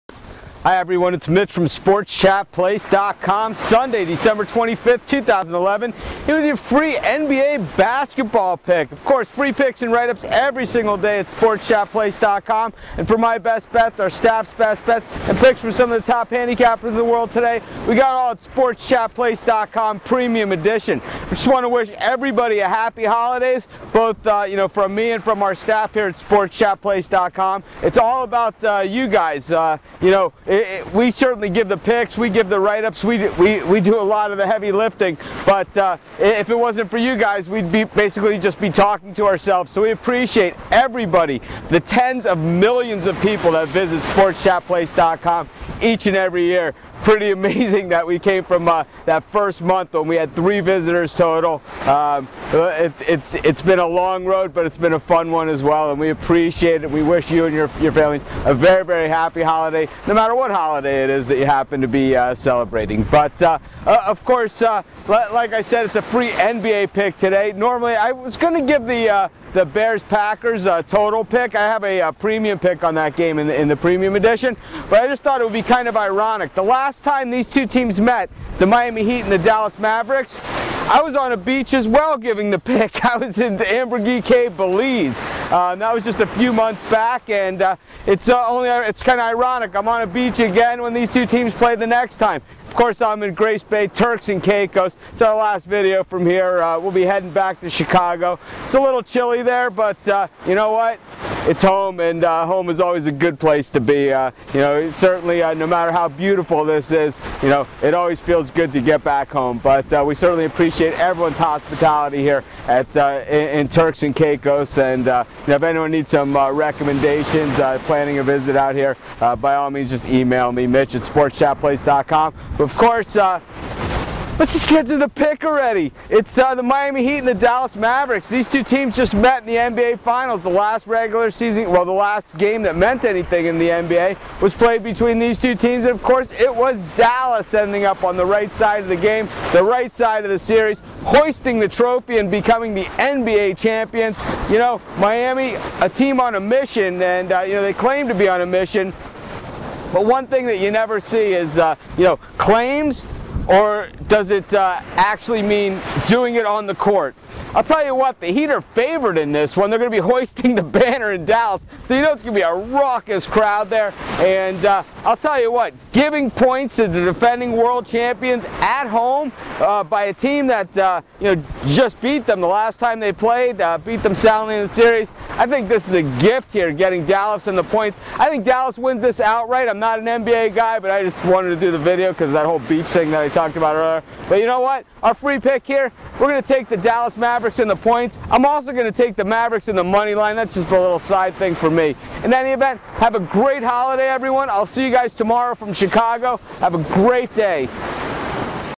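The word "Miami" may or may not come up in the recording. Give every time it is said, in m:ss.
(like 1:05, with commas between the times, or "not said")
1:18, 2:06, 2:24.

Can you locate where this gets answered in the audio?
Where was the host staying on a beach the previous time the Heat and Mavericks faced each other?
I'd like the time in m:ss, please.
1:23.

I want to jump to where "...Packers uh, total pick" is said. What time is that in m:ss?
1:10.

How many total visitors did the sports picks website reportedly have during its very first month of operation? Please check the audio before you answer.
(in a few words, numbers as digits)
3.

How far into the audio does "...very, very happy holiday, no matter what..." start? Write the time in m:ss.
0:58.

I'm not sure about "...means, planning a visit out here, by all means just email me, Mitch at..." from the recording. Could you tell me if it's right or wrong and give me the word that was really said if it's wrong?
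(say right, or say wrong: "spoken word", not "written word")
wrong: "recommendations", not "means".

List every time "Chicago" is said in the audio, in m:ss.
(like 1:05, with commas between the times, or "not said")
1:37, 3:15.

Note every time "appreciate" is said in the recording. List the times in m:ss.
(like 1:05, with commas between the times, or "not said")
0:39, 0:56, 1:50.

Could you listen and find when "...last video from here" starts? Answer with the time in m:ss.
1:35.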